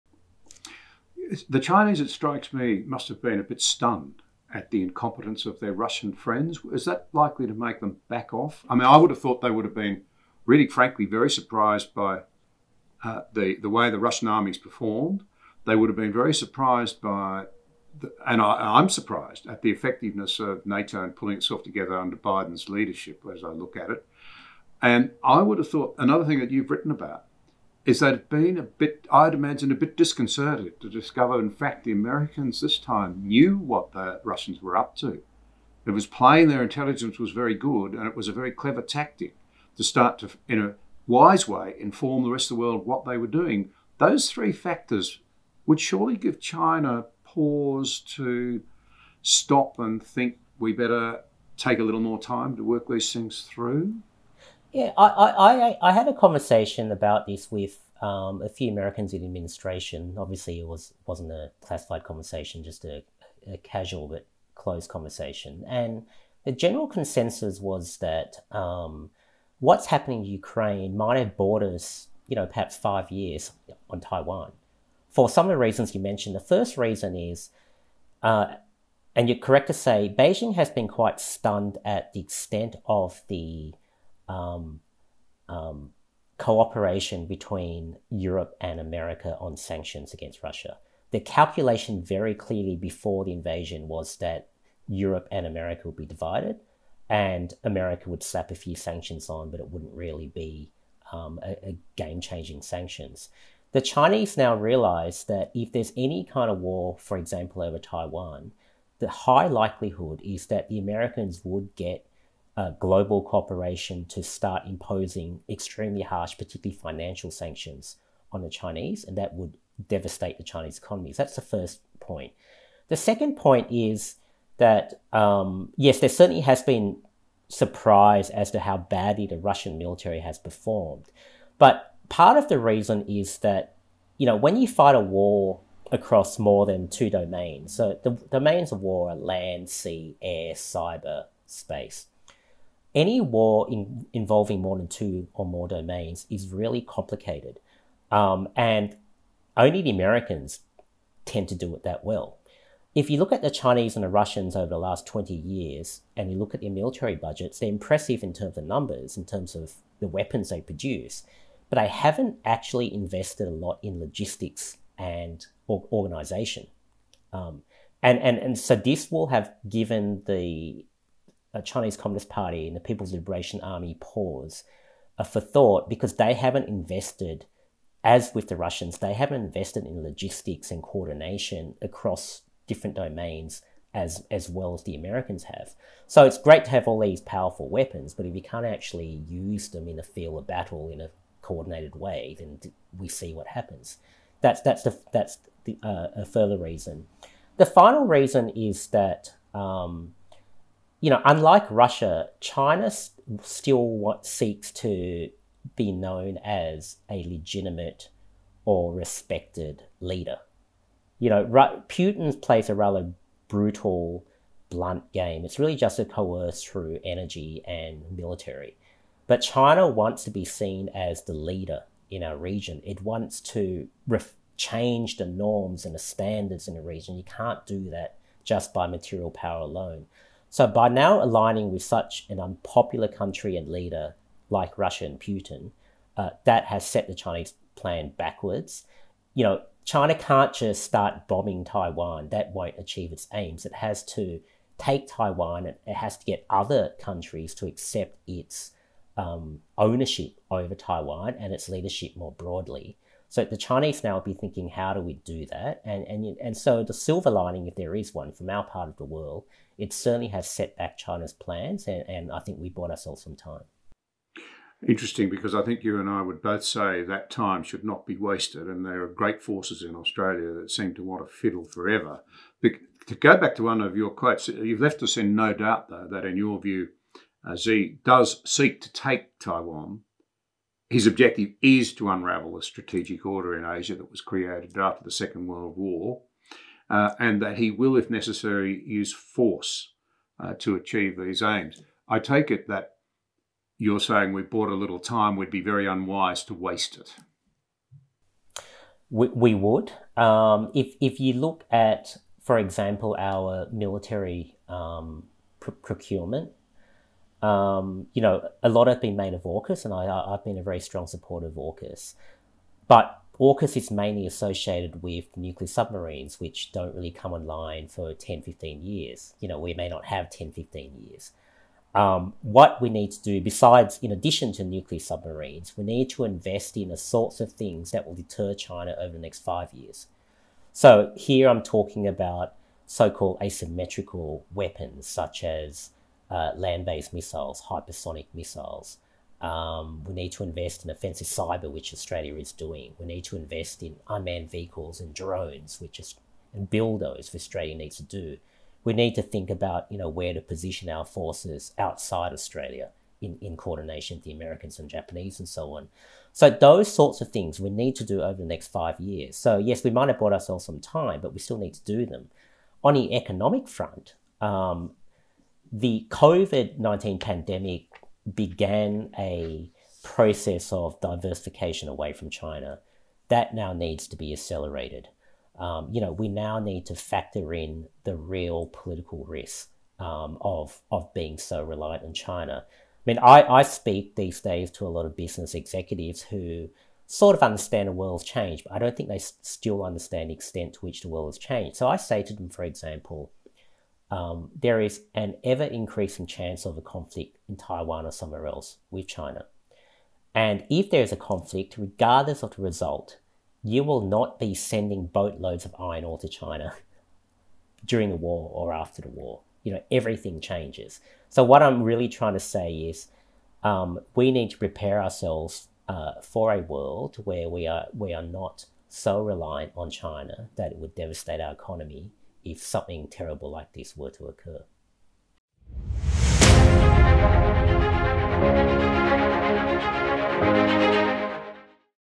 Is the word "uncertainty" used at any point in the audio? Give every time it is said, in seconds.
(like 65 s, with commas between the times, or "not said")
not said.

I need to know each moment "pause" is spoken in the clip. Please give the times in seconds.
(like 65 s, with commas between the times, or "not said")
47 s, 173 s.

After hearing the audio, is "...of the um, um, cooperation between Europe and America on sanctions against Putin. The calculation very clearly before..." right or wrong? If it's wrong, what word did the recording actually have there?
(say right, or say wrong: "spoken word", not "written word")
wrong: "Russia", not "Putin".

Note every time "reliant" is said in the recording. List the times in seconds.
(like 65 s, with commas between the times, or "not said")
381 s, 419 s.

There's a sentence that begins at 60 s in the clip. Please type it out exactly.
Obviously, it was wasn't a classified conversation, just a, a casual but close conversation.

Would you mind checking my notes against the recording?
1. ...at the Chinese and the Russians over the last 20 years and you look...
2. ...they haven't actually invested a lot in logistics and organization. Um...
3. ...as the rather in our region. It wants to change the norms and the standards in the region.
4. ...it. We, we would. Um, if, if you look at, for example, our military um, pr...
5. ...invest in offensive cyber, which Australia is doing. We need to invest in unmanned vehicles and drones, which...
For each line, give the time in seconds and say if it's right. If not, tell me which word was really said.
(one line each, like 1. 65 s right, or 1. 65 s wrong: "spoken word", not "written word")
1. 153 s right
2. 161 s right
3. 220 s wrong: "leader", not "rather"
4. 296 s right
5. 340 s right.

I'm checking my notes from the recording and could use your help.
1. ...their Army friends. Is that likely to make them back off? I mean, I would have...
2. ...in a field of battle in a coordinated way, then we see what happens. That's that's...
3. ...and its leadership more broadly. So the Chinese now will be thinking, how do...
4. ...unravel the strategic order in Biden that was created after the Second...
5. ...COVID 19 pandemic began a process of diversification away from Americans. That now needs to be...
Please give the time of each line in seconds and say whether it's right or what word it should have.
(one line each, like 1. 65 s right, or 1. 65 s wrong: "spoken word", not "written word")
1. 5 s wrong: "Russian", not "Army"
2. 189 s right
3. 251 s right
4. 282 s wrong: "Asia", not "Biden"
5. 366 s wrong: "China", not "Americans".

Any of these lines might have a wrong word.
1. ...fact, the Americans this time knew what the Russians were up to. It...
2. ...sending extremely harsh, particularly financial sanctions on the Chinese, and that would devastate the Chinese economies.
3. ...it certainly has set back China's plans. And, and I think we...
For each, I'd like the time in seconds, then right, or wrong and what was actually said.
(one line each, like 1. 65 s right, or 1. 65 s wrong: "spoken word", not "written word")
1. 31 s right
2. 114 s wrong: "imposing", not "sending"
3. 259 s right.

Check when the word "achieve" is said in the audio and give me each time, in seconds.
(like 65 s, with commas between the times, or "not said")
242 s, 290 s.